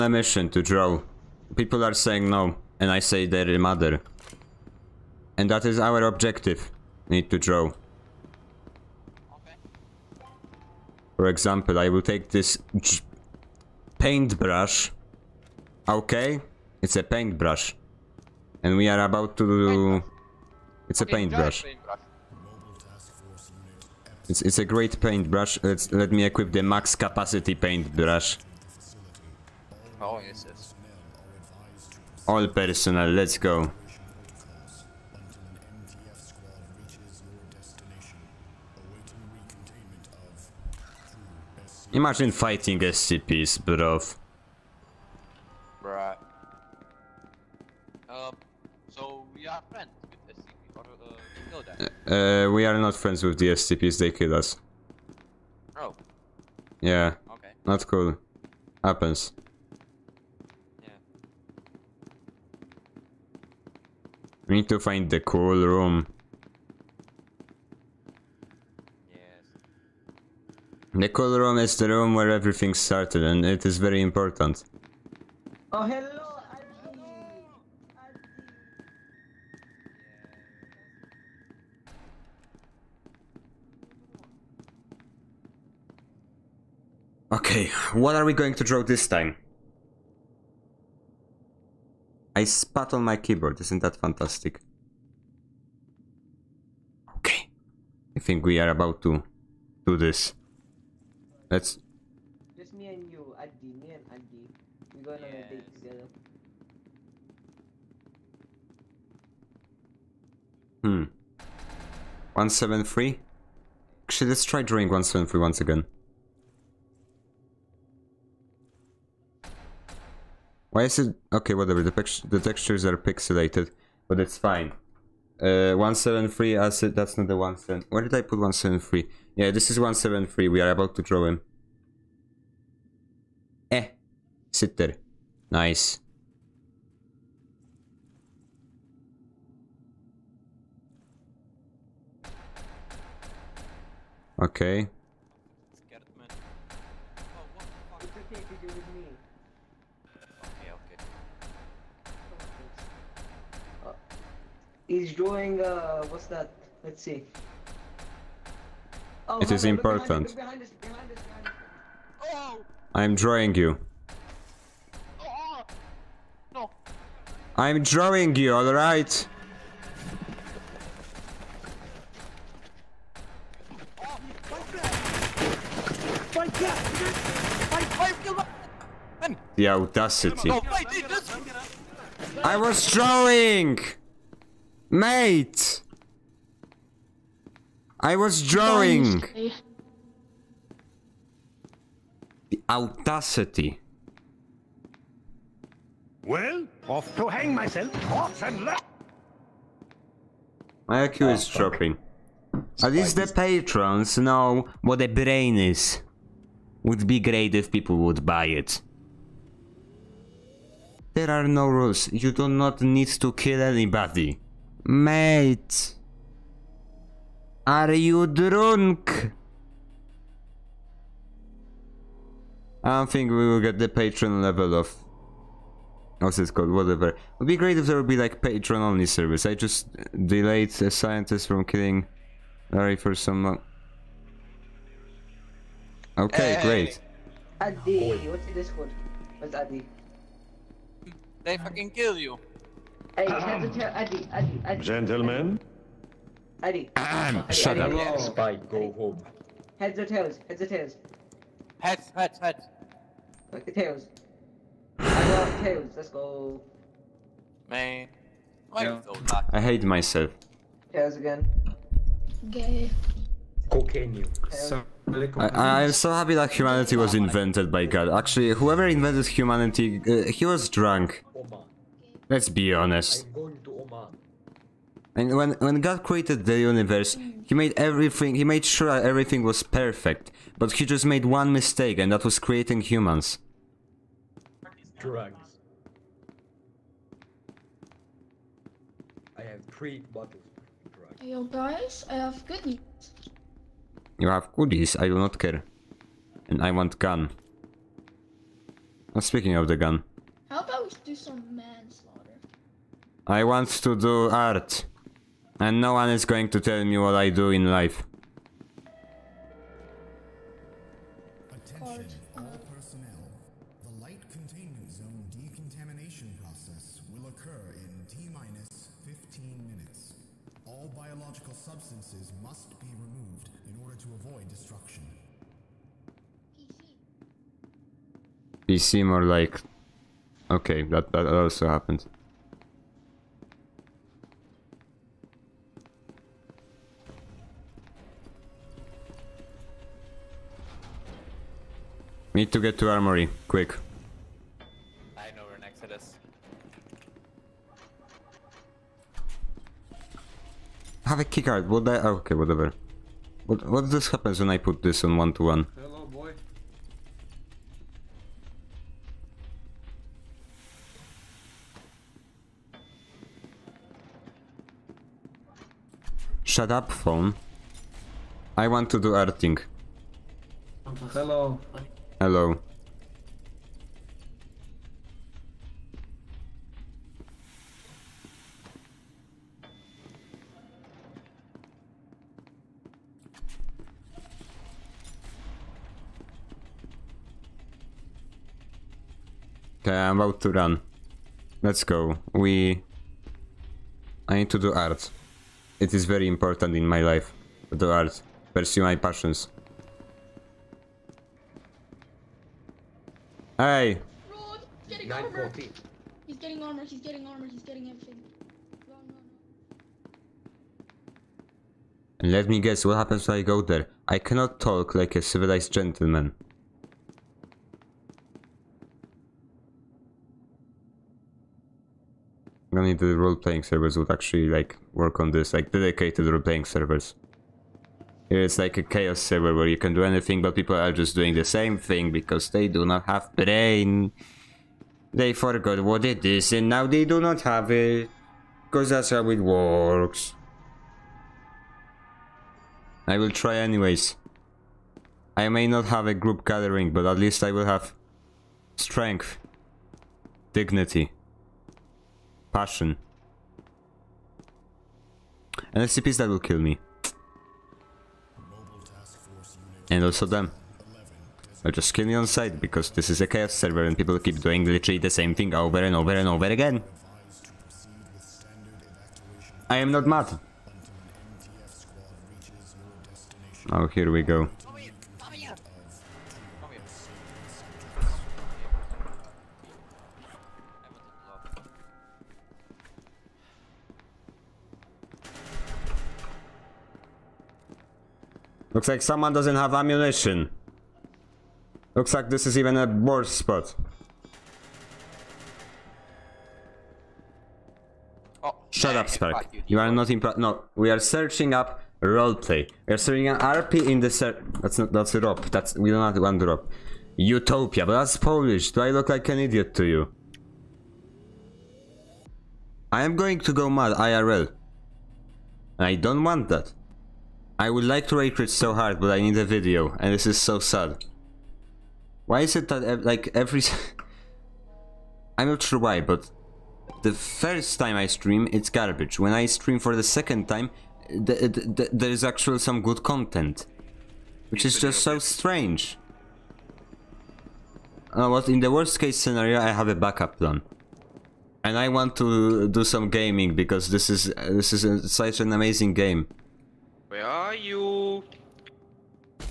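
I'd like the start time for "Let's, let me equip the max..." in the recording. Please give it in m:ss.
0:25.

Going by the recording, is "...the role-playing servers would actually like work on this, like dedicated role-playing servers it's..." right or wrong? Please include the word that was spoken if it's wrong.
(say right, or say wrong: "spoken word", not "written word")
right.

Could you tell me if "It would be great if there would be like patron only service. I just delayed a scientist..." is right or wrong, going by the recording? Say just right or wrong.
right.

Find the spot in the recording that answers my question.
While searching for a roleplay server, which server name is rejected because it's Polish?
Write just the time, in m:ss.
8:27.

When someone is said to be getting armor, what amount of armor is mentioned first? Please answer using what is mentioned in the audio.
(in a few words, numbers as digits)
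9.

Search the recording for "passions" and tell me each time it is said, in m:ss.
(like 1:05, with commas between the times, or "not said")
6:38, 7:32.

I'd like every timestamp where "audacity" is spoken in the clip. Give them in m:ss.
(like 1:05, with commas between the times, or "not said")
2:59, 3:12.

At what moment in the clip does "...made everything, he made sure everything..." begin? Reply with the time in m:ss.
4:37.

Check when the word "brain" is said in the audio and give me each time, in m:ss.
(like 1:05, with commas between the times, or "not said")
3:25, 7:13.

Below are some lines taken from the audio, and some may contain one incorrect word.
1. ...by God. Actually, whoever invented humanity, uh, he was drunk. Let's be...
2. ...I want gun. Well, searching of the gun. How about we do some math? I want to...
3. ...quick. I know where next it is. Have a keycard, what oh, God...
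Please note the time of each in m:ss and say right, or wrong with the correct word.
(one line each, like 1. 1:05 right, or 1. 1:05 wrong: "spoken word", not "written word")
1. 4:27 right
2. 4:56 wrong: "speaking", not "searching"
3. 5:43 wrong: "Okay", not "God".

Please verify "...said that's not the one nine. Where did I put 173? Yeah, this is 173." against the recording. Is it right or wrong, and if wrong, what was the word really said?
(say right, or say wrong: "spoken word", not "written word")
wrong: "seven", not "nine".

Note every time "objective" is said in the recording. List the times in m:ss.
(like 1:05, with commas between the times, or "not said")
0:06.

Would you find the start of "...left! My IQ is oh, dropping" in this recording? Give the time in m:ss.
3:18.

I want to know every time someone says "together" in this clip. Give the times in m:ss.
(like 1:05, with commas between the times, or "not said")
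1:45.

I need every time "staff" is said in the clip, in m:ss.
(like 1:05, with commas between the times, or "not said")
not said.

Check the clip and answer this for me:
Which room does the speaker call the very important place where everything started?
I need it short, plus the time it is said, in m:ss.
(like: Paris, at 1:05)
The cold room, at 1:11.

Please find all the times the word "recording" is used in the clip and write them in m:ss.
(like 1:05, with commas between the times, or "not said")
not said.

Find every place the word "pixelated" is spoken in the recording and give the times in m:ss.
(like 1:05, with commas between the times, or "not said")
2:02.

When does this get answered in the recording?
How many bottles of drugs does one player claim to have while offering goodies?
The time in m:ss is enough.
4:49.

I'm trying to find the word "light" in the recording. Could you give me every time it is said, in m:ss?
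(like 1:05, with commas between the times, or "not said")
5:14.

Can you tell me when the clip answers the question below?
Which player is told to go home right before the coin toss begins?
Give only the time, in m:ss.
4:08.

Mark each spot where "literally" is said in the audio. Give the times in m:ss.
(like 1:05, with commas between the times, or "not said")
7:44.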